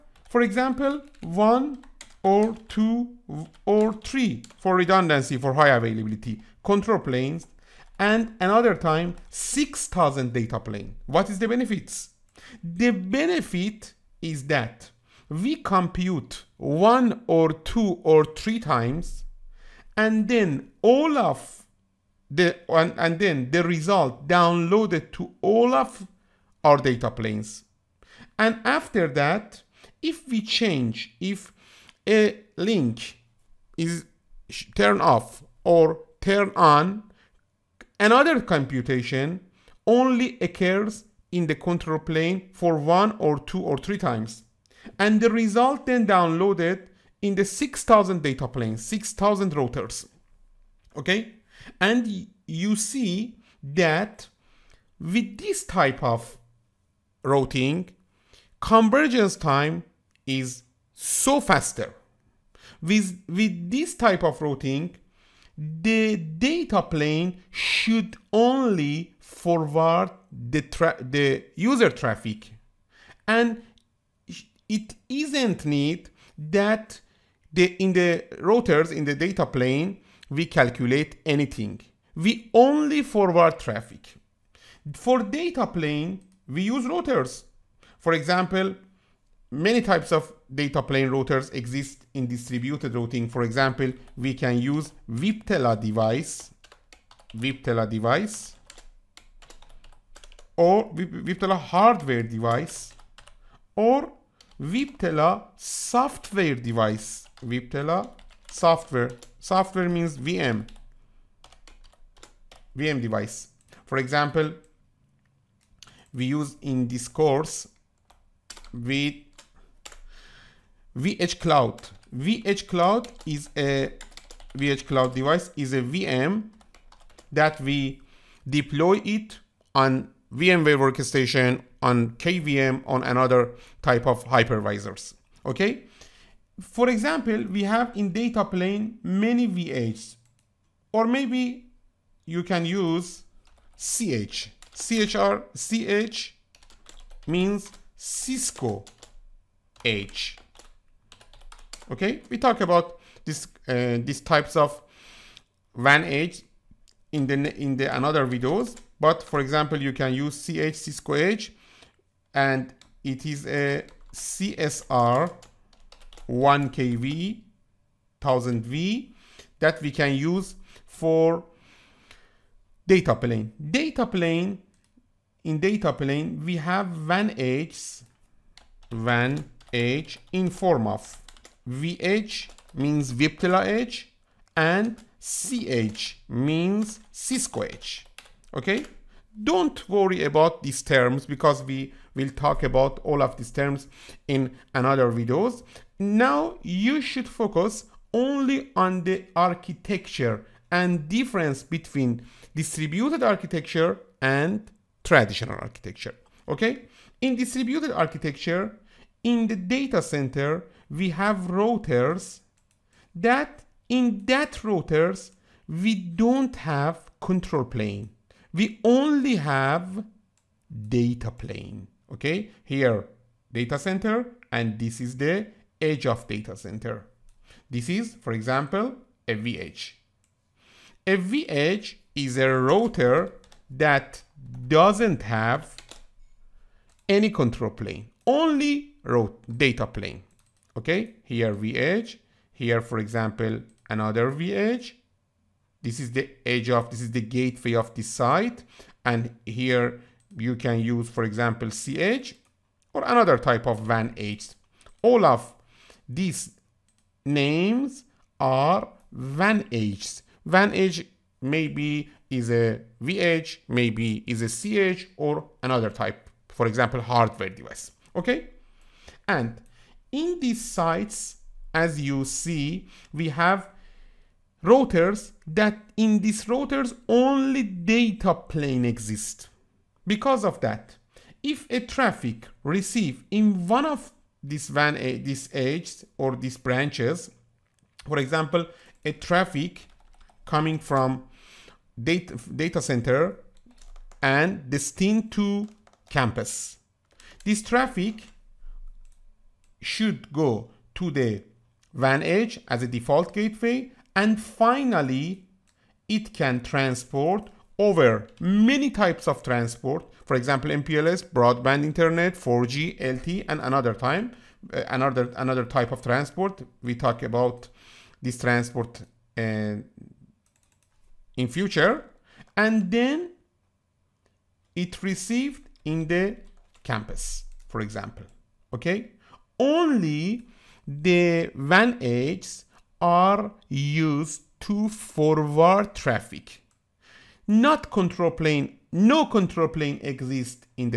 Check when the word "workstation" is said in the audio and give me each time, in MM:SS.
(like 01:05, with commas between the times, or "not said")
02:10.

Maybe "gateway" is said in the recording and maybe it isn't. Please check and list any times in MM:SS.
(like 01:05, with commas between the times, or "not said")
04:07, 05:03.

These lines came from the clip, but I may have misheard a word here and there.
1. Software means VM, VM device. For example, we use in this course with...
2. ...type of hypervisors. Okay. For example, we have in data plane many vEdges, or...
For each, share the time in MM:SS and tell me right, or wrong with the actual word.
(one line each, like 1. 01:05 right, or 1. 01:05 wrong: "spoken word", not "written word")
1. 01:49 right
2. 02:13 right.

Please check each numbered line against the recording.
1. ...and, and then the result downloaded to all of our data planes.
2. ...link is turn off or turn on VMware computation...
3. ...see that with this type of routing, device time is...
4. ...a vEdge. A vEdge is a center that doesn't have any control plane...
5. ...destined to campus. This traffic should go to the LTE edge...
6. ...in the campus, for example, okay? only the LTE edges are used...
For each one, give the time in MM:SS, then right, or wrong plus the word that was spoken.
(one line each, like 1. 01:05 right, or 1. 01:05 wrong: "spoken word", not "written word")
1. 00:22 right
2. 00:32 wrong: "Another", not "VMware"
3. 00:52 wrong: "convergence", not "device"
4. 03:49 wrong: "router", not "center"
5. 04:54 wrong: "WAN", not "LTE"
6. 05:25 wrong: "WAN", not "LTE".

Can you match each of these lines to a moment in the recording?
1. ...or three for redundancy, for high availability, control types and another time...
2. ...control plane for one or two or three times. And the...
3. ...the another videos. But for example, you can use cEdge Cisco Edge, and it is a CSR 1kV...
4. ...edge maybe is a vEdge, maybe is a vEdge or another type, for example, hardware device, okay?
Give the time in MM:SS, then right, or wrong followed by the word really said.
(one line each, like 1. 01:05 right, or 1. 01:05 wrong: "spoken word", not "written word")
1. 00:03 wrong: "planes", not "types"
2. 00:41 right
3. 02:37 right
4. 04:20 wrong: "cEdge", not "vEdge".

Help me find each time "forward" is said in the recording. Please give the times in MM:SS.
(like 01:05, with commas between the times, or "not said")
01:09, 01:23, 05:34.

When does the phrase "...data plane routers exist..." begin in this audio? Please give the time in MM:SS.
01:30.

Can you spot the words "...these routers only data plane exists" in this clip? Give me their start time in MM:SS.
04:36.